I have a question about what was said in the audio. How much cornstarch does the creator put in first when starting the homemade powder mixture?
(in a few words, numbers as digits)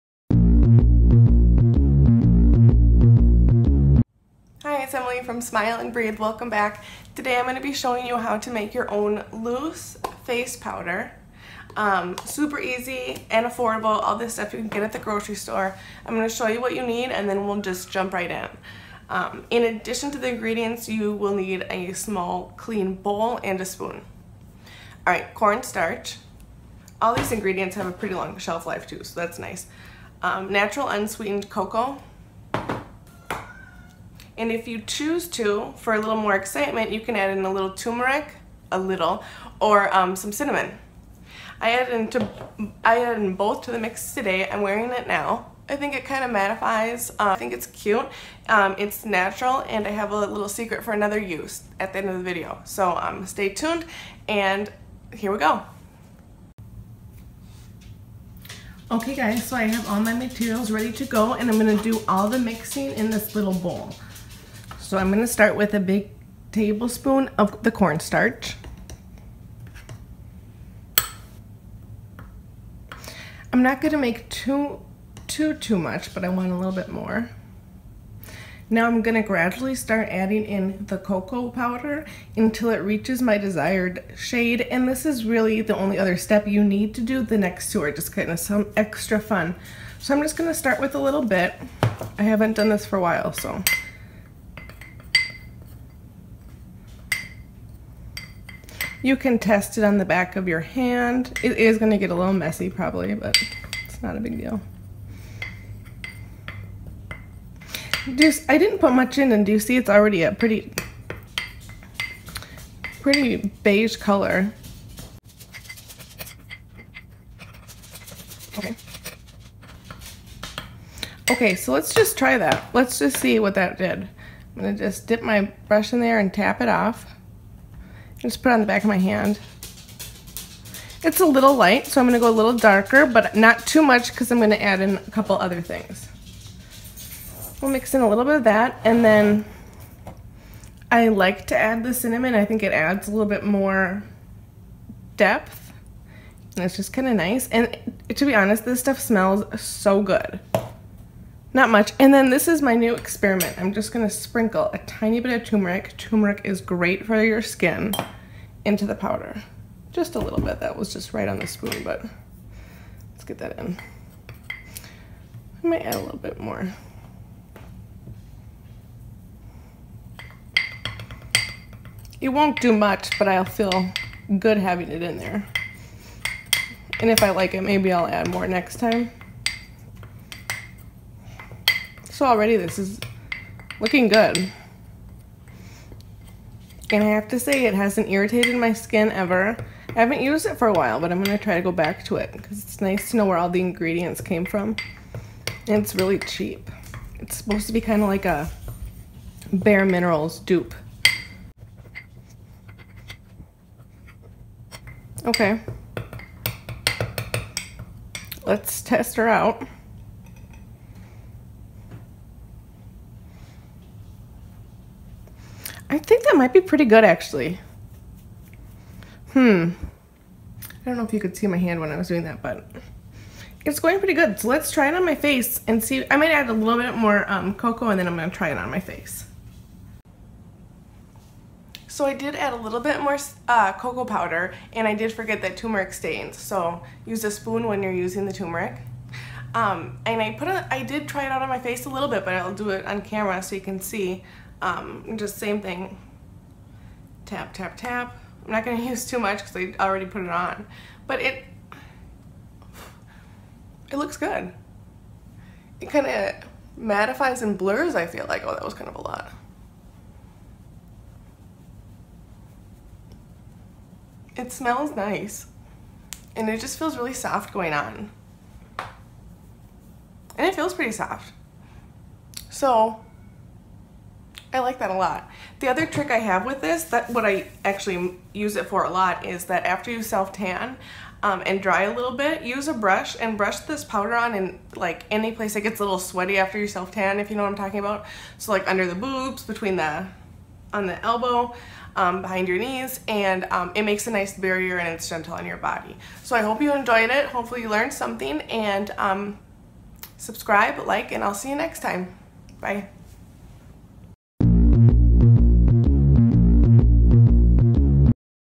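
a big tablespoon.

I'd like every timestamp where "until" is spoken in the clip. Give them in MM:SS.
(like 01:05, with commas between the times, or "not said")
01:22.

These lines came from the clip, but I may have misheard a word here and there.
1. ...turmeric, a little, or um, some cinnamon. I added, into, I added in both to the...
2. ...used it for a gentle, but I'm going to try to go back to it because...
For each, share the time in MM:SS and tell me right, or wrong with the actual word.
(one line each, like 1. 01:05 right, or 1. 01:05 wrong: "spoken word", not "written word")
1. 00:37 right
2. 03:10 wrong: "while", not "gentle".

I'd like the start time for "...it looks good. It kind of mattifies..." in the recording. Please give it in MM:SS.
04:13.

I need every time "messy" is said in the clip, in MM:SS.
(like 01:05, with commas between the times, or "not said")
01:42.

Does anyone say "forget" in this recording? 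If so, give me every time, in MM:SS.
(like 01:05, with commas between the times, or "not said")
03:55.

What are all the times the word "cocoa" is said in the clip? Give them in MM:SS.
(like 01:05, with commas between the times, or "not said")
00:31, 01:20, 03:47, 03:53.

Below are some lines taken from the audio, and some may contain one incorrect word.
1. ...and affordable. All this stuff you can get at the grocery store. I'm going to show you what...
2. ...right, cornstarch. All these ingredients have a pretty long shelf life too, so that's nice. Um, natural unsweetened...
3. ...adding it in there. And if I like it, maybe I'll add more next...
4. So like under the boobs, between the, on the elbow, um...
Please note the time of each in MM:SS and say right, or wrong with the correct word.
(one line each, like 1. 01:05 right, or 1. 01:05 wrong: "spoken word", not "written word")
1. 00:13 right
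2. 00:25 right
3. 02:54 wrong: "having", not "adding"
4. 04:48 right.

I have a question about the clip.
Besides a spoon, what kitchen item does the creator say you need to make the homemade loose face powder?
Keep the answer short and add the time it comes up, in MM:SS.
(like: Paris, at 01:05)
small clean bowl, at 00:21.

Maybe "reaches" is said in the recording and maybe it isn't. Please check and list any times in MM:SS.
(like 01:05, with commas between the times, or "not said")
01:22.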